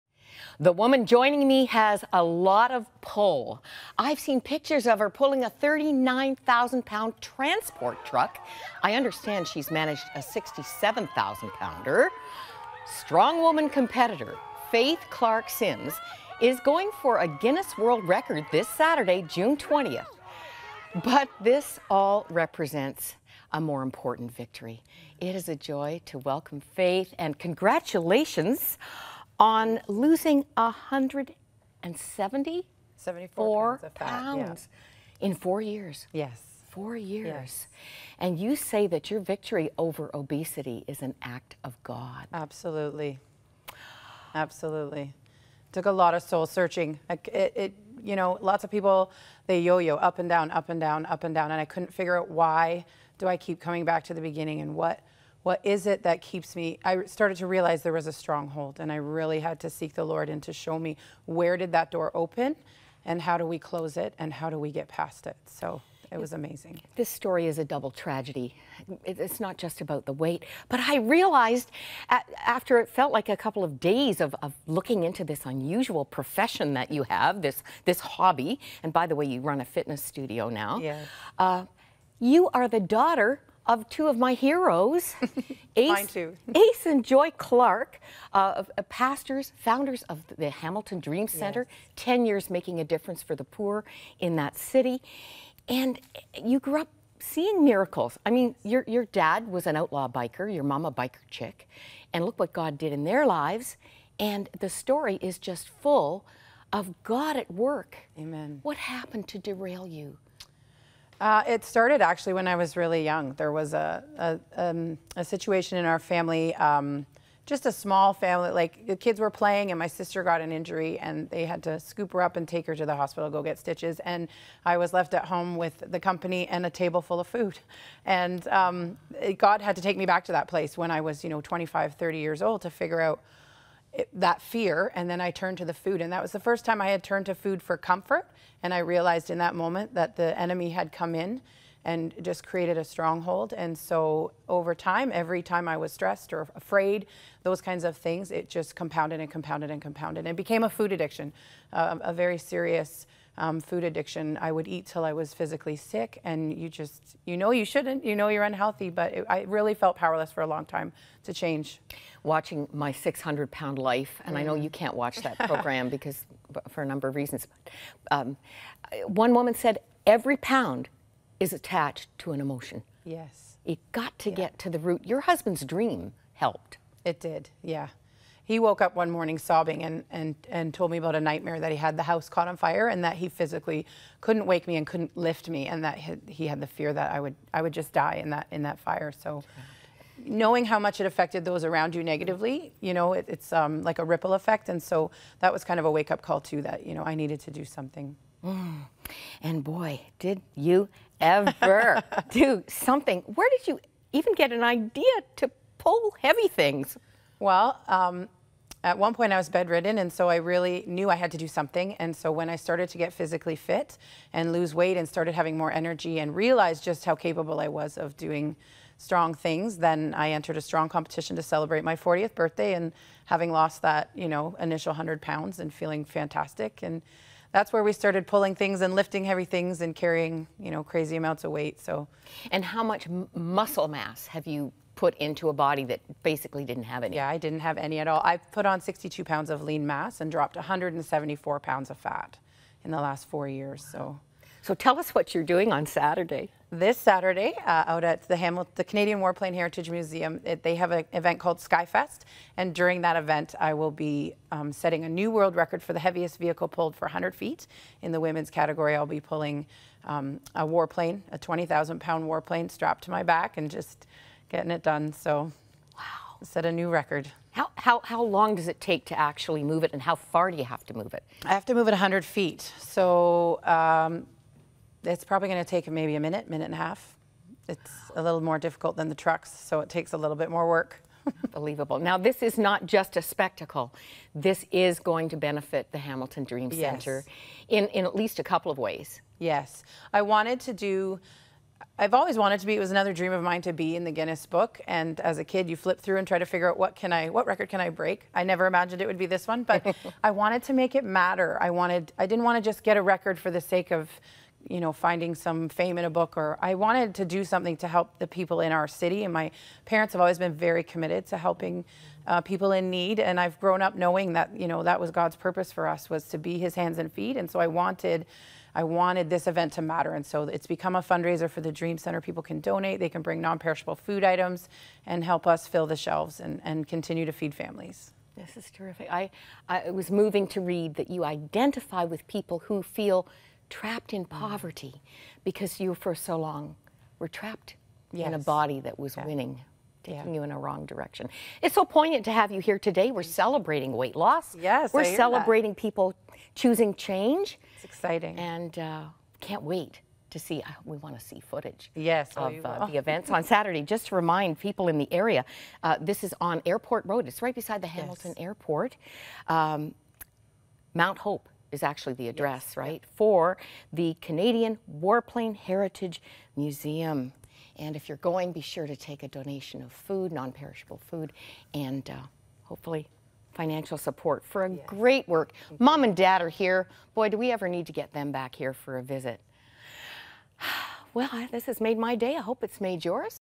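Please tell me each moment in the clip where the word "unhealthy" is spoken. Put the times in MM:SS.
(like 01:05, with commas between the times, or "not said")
02:38.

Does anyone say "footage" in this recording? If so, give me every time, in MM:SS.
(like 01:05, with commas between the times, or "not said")
05:51.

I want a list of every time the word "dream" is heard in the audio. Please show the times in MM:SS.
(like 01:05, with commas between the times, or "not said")
01:30, 02:55, 04:46, 04:53, 05:21.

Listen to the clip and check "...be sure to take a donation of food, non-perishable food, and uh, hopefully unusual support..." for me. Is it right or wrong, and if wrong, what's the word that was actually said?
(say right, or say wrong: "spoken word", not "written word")
wrong: "financial", not "unusual".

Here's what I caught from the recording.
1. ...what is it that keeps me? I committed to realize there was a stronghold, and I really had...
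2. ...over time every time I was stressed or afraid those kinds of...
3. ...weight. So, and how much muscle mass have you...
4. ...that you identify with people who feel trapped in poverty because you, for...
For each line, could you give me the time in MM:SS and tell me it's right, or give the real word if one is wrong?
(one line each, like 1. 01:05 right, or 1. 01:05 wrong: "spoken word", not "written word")
1. 00:55 wrong: "started", not "committed"
2. 02:24 right
3. 03:51 right
4. 05:30 right.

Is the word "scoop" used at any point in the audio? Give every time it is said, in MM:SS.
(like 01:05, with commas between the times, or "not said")
02:01.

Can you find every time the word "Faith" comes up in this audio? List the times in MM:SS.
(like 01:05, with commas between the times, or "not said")
00:14, 00:26.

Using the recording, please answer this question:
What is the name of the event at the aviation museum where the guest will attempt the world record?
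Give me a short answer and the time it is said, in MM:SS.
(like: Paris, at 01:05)
Skyfest, at 04:11.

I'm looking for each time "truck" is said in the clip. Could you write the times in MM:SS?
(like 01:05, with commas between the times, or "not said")
00:08, 04:39.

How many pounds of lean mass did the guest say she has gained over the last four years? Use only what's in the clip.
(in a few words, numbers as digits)
62 pounds.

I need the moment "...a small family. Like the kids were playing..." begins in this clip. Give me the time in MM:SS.
01:57.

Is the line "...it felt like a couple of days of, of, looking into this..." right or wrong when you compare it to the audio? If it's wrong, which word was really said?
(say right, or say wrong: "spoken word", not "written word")
right.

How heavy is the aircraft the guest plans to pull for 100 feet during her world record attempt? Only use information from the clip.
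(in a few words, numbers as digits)
20,000 pounds.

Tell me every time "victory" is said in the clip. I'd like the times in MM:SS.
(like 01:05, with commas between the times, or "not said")
00:24, 00:39.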